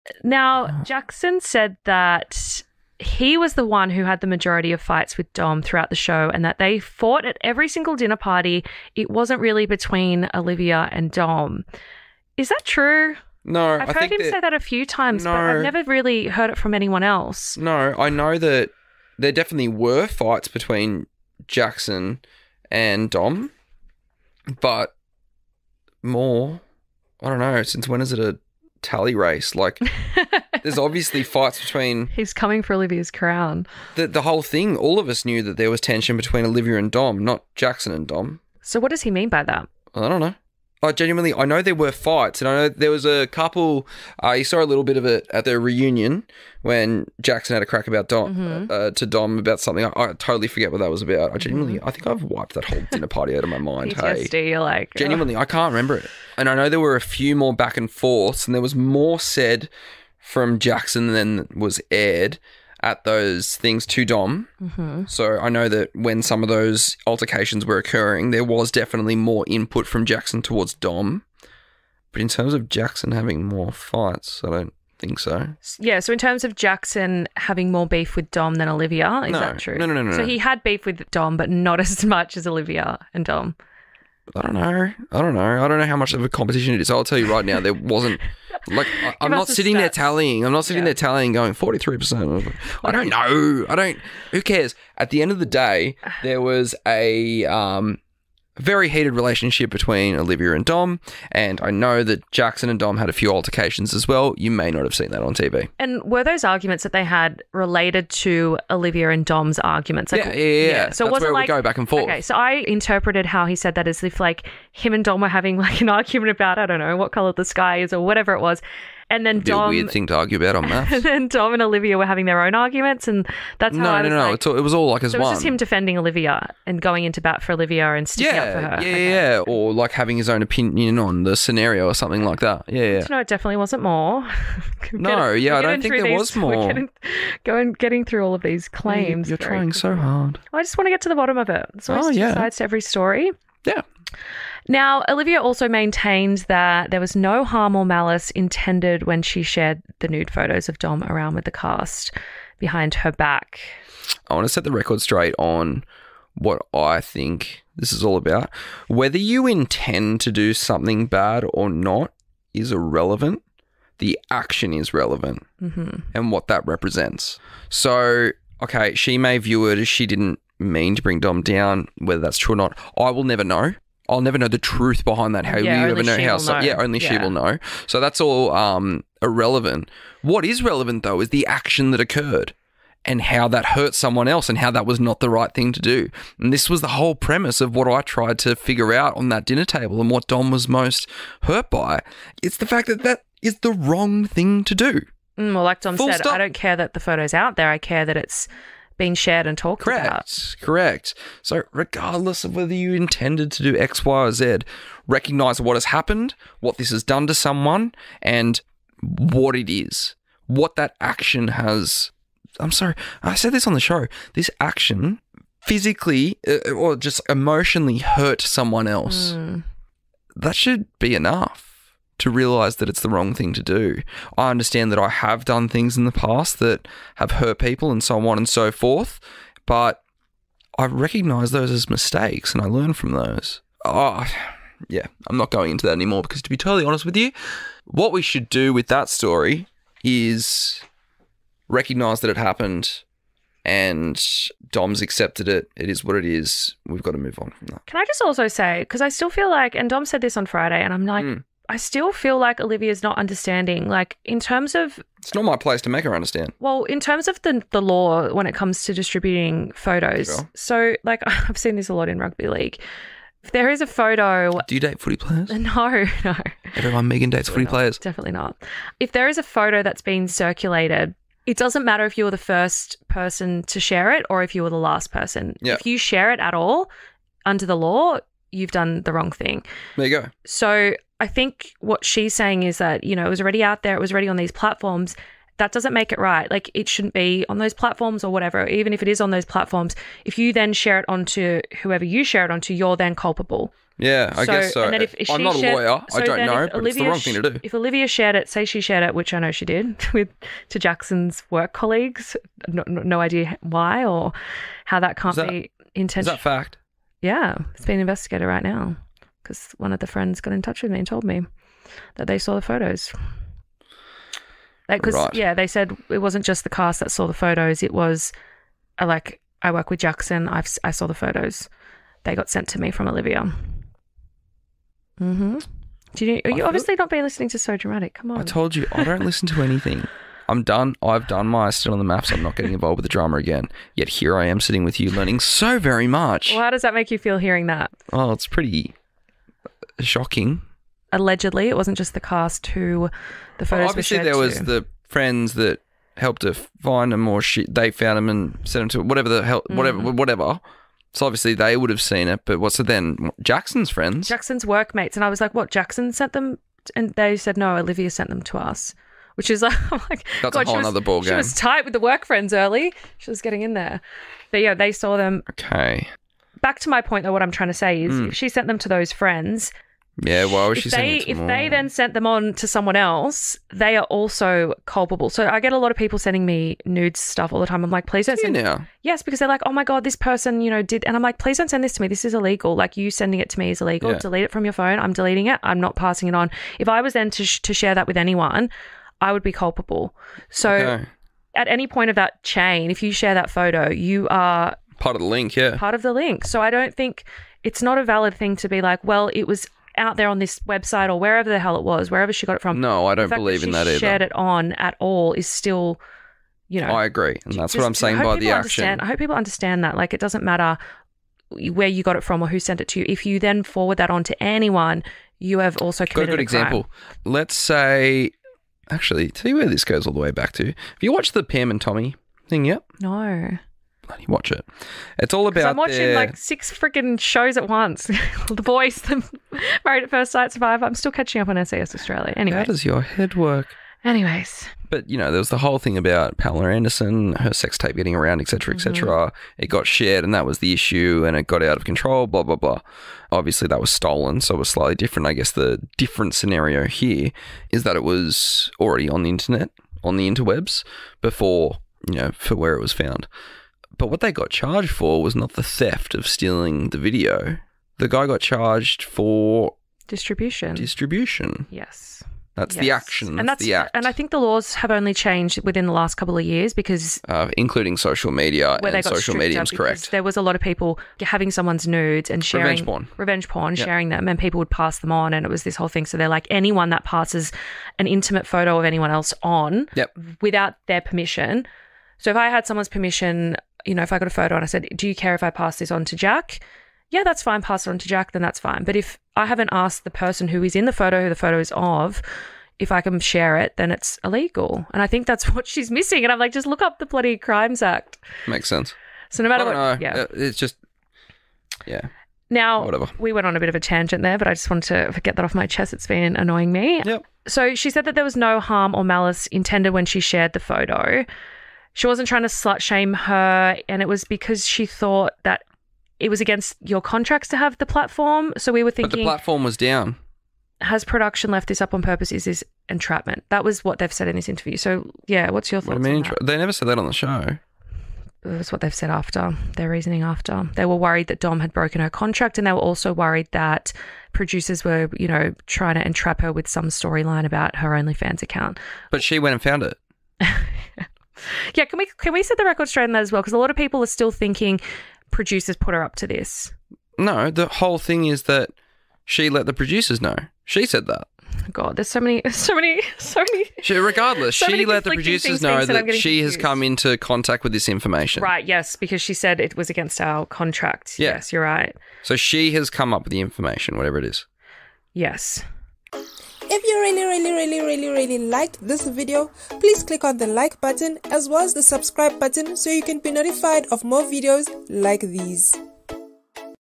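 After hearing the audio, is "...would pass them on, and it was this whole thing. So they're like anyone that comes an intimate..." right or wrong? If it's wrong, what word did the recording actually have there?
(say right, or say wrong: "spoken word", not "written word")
wrong: "passes", not "comes".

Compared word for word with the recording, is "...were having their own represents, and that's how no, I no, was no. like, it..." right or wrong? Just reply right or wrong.
wrong.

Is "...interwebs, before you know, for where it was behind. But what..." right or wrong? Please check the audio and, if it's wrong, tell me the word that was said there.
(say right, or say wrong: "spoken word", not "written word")
wrong: "found", not "behind".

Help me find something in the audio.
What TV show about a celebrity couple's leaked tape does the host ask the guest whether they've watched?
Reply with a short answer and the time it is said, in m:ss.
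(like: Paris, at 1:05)
Pam and Tommy, at 7:01.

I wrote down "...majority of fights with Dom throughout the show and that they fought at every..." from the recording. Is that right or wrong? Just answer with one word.
right.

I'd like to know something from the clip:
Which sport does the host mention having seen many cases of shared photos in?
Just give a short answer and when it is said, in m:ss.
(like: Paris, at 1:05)
Rugby league, at 4:22.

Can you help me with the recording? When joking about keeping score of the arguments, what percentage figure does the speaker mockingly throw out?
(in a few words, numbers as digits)
43 percent.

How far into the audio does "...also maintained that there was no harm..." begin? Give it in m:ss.
2:25.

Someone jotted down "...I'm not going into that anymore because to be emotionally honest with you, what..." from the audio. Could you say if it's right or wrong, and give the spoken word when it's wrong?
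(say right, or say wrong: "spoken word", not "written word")
wrong: "totally", not "emotionally".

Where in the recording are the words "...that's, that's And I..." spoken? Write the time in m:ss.
7:43.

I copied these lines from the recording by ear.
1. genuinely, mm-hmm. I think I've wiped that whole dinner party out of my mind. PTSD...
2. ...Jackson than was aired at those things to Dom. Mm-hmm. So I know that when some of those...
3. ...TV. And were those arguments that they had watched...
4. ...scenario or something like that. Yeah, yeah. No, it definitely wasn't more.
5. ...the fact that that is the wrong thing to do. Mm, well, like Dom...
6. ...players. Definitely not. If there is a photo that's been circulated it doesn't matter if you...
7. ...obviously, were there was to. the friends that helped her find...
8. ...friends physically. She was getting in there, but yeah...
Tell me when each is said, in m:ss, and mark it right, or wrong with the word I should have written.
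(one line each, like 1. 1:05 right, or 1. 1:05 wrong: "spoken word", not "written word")
1. 0:51 right
2. 1:00 right
3. 1:45 wrong: "related", not "watched"
4. 2:11 right
5. 3:12 right
6. 4:27 right
7. 5:43 right
8. 6:02 wrong: "early", not "physically".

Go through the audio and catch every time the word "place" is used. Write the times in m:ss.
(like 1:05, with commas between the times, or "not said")
4:15.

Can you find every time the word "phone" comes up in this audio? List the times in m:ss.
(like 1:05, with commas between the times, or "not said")
6:24.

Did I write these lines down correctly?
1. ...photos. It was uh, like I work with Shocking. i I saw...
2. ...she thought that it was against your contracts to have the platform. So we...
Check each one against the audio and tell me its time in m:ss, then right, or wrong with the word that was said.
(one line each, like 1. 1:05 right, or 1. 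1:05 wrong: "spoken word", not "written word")
1. 5:17 wrong: "Jackson", not "Shocking"
2. 8:34 right.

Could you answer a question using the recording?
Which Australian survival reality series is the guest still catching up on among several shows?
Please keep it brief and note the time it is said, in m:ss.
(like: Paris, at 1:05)
SAS Australia, at 7:11.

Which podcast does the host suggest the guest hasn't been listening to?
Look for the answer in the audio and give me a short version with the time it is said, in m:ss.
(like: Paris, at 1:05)
So Dramatic, at 5:27.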